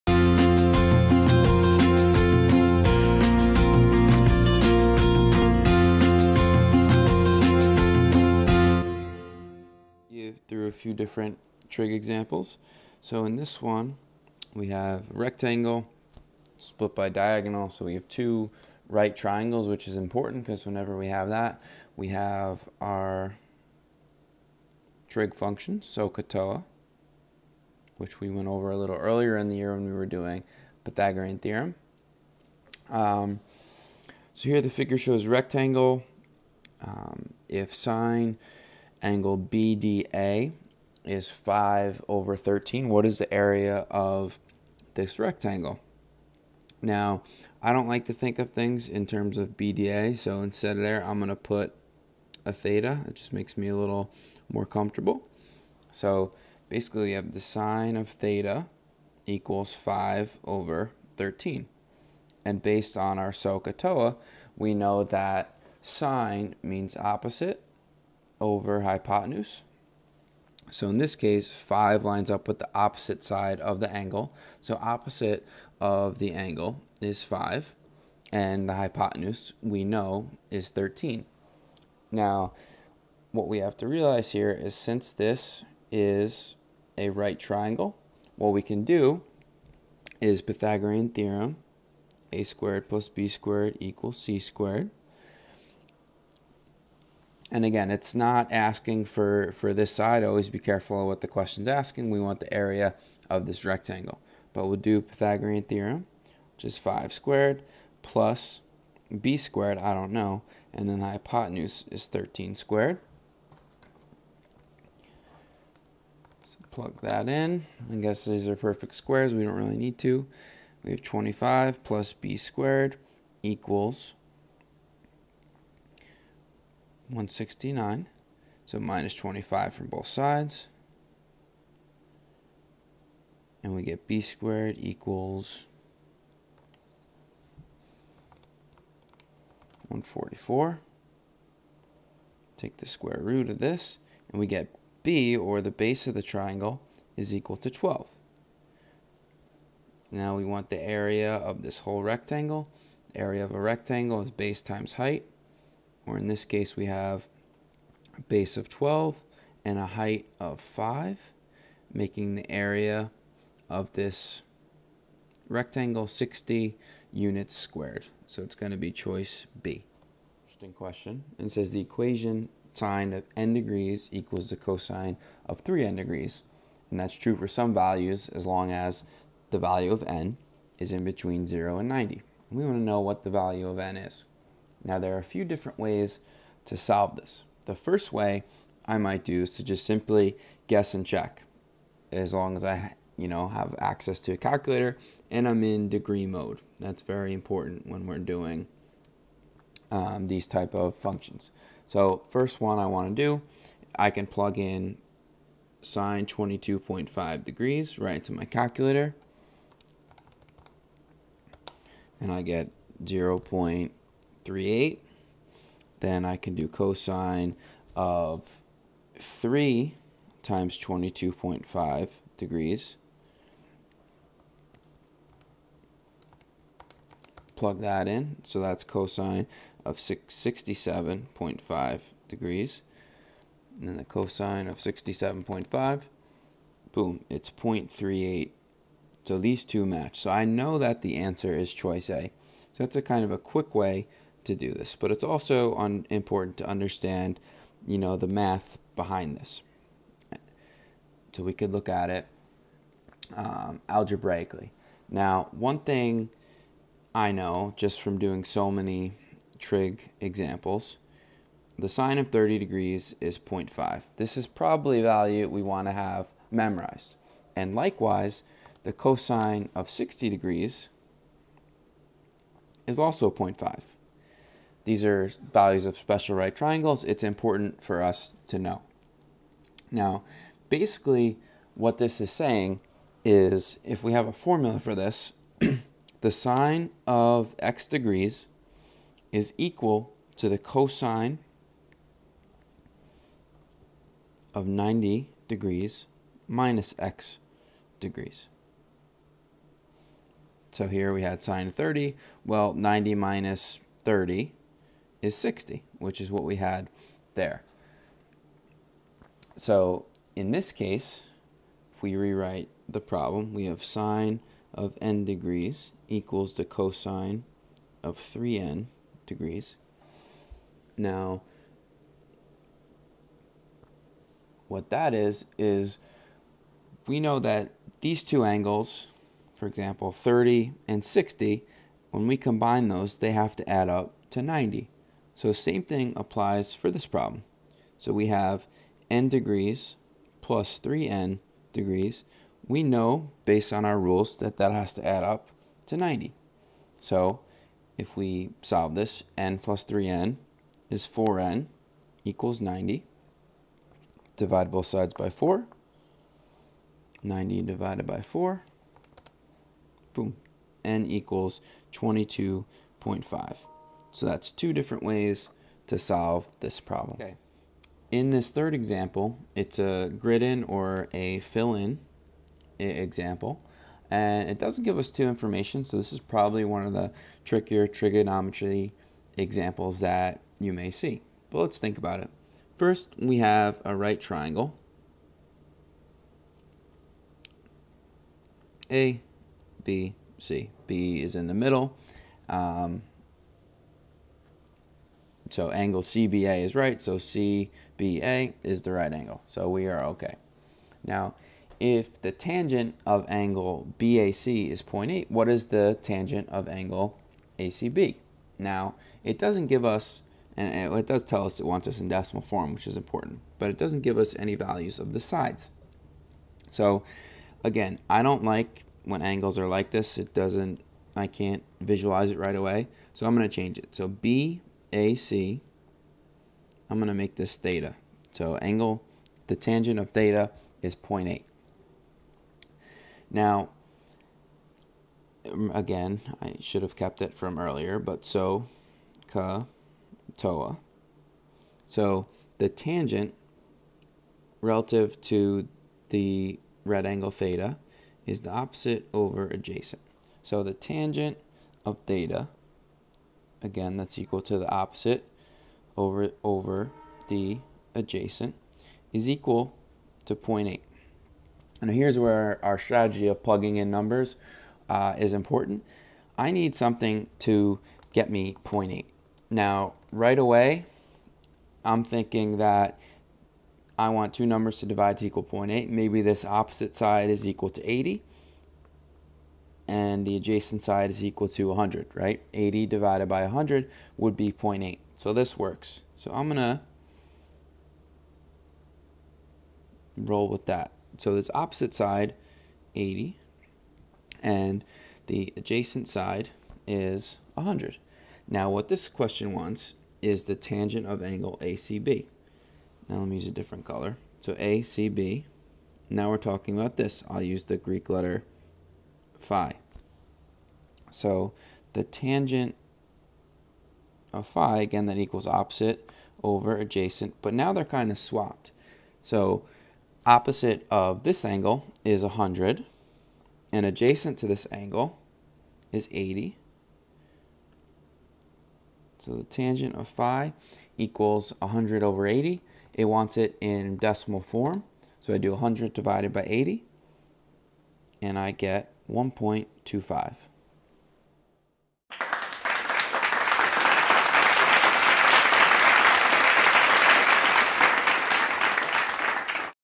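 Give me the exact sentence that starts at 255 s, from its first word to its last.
Now, one thing I know just from doing so many trig examples, the sine of 30 degrees is 0.5.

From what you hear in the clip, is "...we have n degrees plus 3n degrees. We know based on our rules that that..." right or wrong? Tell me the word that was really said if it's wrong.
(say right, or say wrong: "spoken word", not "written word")
right.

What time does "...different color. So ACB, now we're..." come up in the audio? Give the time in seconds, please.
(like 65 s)
503 s.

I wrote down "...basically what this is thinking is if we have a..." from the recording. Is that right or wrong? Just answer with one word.
wrong.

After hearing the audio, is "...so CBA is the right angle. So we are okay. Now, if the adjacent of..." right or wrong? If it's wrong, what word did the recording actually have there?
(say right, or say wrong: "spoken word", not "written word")
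wrong: "tangent", not "adjacent".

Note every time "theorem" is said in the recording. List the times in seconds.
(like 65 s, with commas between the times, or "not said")
31 s, 91 s, 105 s.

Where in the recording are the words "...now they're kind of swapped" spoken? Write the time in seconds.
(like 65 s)
517 s.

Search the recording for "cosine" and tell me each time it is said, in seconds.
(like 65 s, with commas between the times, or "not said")
174 s, 216 s, 228 s, 234 s, 268 s, 290 s, 316 s.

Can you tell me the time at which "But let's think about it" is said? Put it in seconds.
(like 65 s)
381 s.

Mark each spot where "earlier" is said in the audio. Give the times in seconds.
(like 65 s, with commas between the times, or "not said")
28 s, 437 s.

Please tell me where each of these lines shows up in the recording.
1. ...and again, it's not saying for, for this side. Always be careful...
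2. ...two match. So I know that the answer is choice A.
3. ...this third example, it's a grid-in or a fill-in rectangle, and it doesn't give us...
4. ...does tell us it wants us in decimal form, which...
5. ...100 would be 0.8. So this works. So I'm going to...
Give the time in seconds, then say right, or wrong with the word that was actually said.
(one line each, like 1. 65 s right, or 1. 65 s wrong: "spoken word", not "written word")
1. 97 s wrong: "asking", not "saying"
2. 239 s right
3. 368 s wrong: "example", not "rectangle"
4. 411 s right
5. 483 s right.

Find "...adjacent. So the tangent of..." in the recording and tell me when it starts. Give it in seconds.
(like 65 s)
449 s.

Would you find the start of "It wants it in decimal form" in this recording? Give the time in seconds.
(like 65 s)
532 s.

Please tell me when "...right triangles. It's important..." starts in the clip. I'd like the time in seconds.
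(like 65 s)
276 s.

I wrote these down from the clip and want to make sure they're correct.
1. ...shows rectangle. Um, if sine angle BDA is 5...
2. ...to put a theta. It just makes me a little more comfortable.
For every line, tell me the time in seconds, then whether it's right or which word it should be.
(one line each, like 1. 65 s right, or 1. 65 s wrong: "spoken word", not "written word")
1. 34 s right
2. 51 s right.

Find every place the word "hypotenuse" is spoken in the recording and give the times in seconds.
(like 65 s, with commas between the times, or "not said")
68 s, 78 s, 111 s.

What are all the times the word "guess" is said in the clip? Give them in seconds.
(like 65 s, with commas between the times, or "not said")
117 s, 190 s.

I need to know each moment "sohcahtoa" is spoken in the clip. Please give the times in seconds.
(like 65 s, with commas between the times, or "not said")
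25 s, 63 s.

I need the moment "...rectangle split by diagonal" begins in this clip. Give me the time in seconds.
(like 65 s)
15 s.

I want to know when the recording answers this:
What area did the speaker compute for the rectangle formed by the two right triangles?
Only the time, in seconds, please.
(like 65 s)
166 s.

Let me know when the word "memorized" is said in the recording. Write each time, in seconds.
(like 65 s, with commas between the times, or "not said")
266 s.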